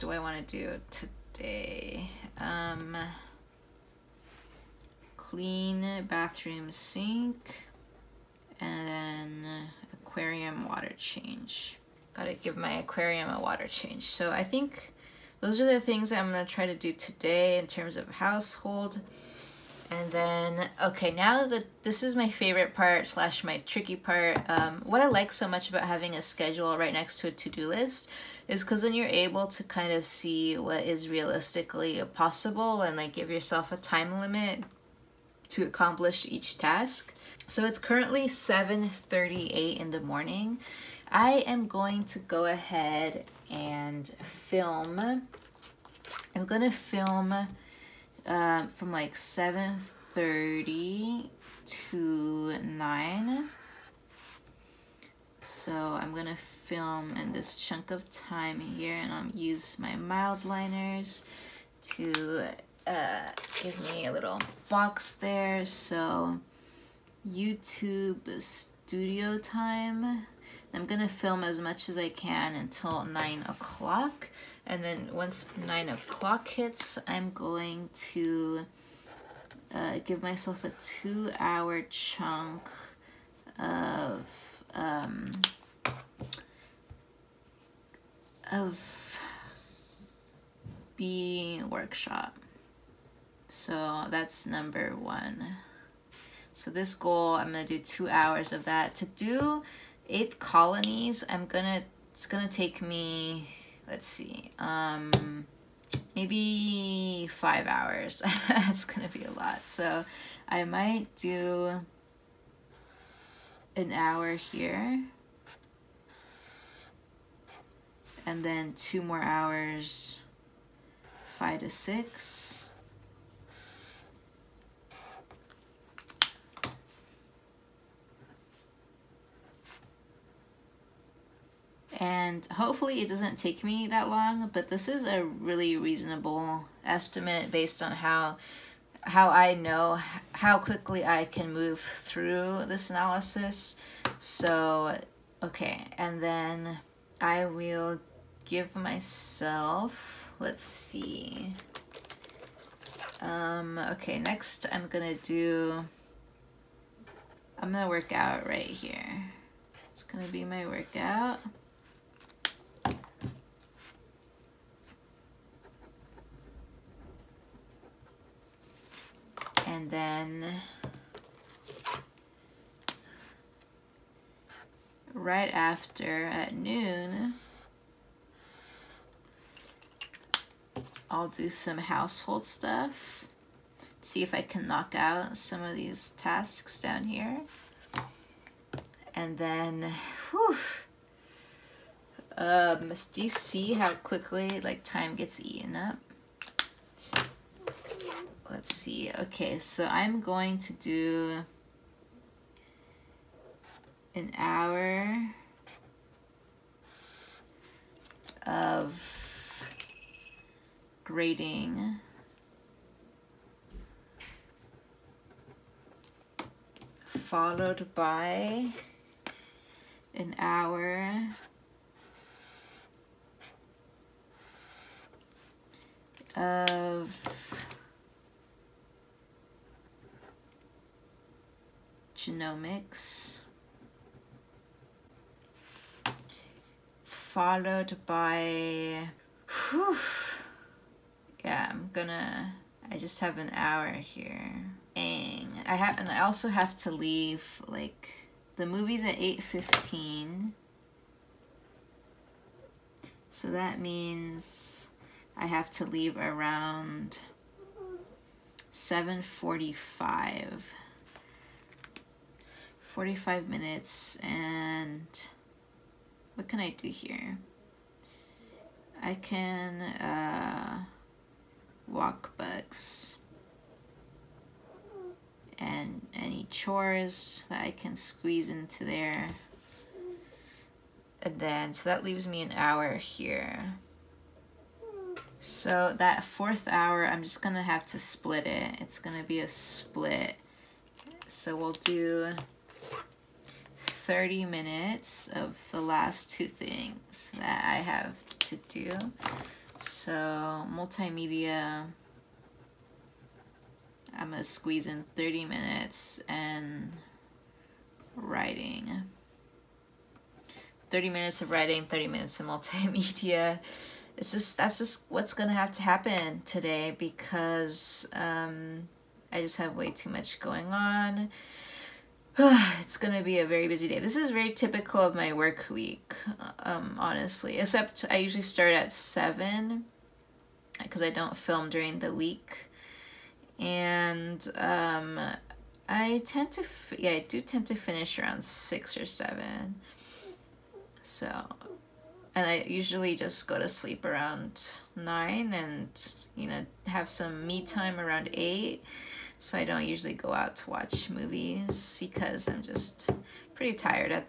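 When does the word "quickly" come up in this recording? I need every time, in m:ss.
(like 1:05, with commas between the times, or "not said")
2:20, 3:13.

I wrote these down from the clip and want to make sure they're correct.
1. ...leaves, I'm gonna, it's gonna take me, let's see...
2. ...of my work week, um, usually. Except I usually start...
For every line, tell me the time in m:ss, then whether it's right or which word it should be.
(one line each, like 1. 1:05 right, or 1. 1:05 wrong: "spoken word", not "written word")
1. 1:40 wrong: "colonies", not "leaves"
2. 5:24 wrong: "honestly", not "usually".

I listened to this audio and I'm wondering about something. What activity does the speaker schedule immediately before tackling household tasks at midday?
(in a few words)
workout.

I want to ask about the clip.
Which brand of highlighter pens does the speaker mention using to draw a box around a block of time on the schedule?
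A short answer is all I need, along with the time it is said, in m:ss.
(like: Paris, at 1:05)
Mildliners, at 0:59.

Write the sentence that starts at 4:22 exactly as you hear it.
45 minutes and what can I do here?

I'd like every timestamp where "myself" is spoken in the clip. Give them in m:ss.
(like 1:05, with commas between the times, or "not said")
1:20, 2:28.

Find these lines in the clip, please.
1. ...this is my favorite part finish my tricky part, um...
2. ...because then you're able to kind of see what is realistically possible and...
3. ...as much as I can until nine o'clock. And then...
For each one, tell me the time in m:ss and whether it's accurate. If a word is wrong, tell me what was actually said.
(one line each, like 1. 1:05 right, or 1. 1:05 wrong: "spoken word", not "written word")
1. 0:21 wrong: "slash", not "finish"
2. 0:28 right
3. 1:11 right.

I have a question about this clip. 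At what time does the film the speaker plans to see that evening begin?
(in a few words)
8:15.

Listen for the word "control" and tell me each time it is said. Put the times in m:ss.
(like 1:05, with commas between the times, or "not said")
not said.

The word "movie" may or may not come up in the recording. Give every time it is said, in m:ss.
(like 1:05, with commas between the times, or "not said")
4:08, 5:51.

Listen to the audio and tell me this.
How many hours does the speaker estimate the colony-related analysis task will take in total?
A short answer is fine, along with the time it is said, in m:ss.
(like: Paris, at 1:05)
5 hours, at 1:47.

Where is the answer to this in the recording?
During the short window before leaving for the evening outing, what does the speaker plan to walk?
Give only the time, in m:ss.
4:32.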